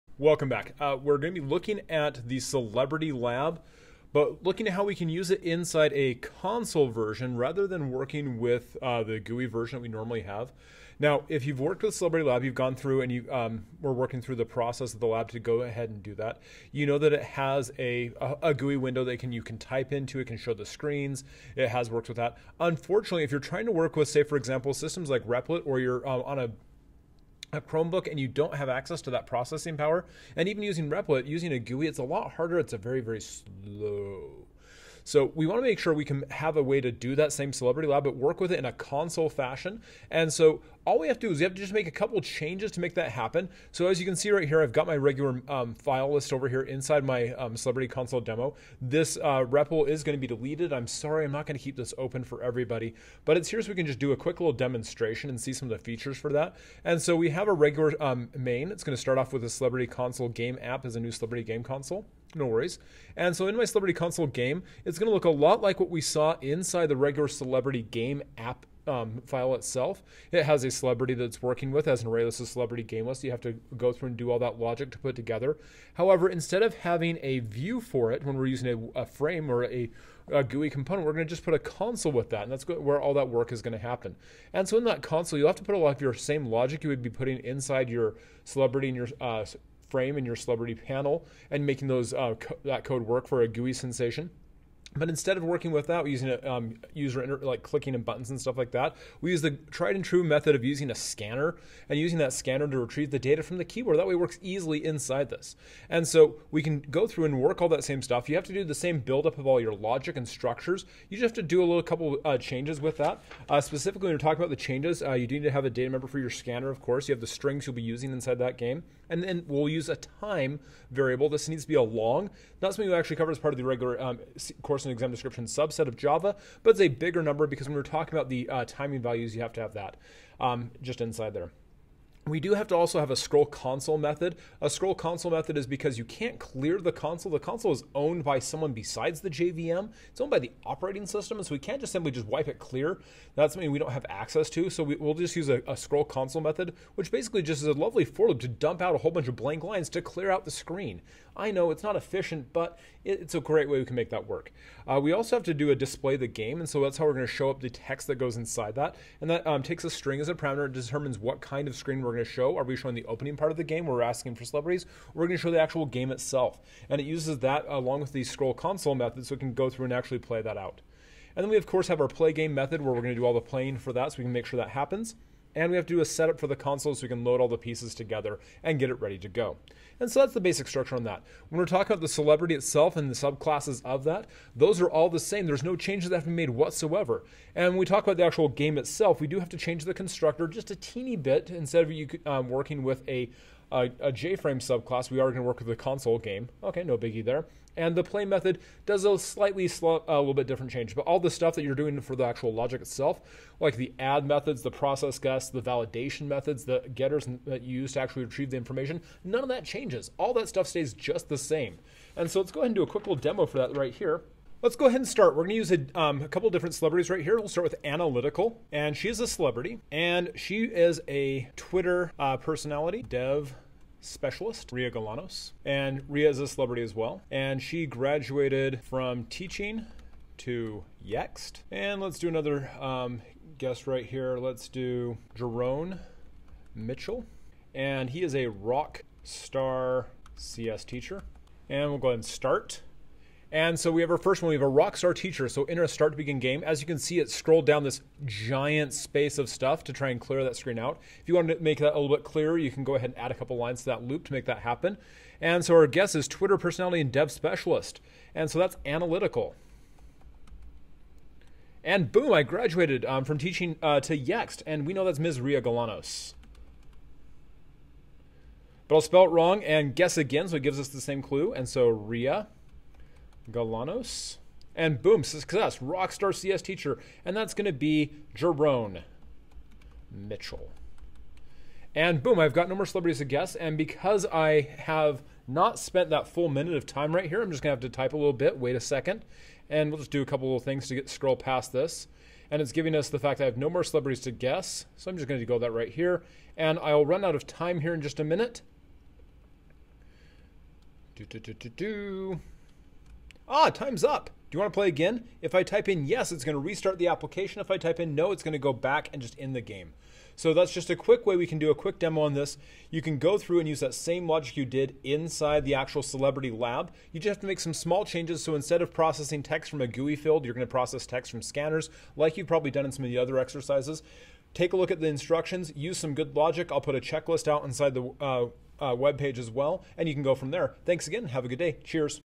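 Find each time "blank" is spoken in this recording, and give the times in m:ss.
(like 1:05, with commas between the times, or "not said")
2:29.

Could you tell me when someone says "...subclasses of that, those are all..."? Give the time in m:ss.
3:03.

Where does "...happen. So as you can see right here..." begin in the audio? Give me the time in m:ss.
0:43.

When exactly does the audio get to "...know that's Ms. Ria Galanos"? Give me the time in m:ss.
4:24.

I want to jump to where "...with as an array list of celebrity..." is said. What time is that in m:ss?
1:11.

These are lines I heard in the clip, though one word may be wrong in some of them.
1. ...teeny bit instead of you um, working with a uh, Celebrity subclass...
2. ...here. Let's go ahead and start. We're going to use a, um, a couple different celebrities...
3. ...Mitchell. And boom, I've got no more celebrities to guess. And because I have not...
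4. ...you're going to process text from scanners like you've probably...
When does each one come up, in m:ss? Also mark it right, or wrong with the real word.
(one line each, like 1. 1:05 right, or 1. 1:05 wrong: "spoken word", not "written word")
1. 3:10 wrong: "JFrame", not "Celebrity"
2. 3:33 right
3. 4:40 right
4. 5:20 right.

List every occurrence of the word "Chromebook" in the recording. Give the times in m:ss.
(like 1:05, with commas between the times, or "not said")
0:27.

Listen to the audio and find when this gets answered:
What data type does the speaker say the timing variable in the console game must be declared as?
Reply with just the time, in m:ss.
2:01.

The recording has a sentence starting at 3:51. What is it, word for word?
And let's do another um, guess right here.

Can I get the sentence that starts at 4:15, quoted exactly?
And so our guess is Twitter personality and dev specialist.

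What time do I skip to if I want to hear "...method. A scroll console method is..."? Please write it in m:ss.
2:13.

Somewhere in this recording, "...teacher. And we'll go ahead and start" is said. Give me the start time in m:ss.
4:00.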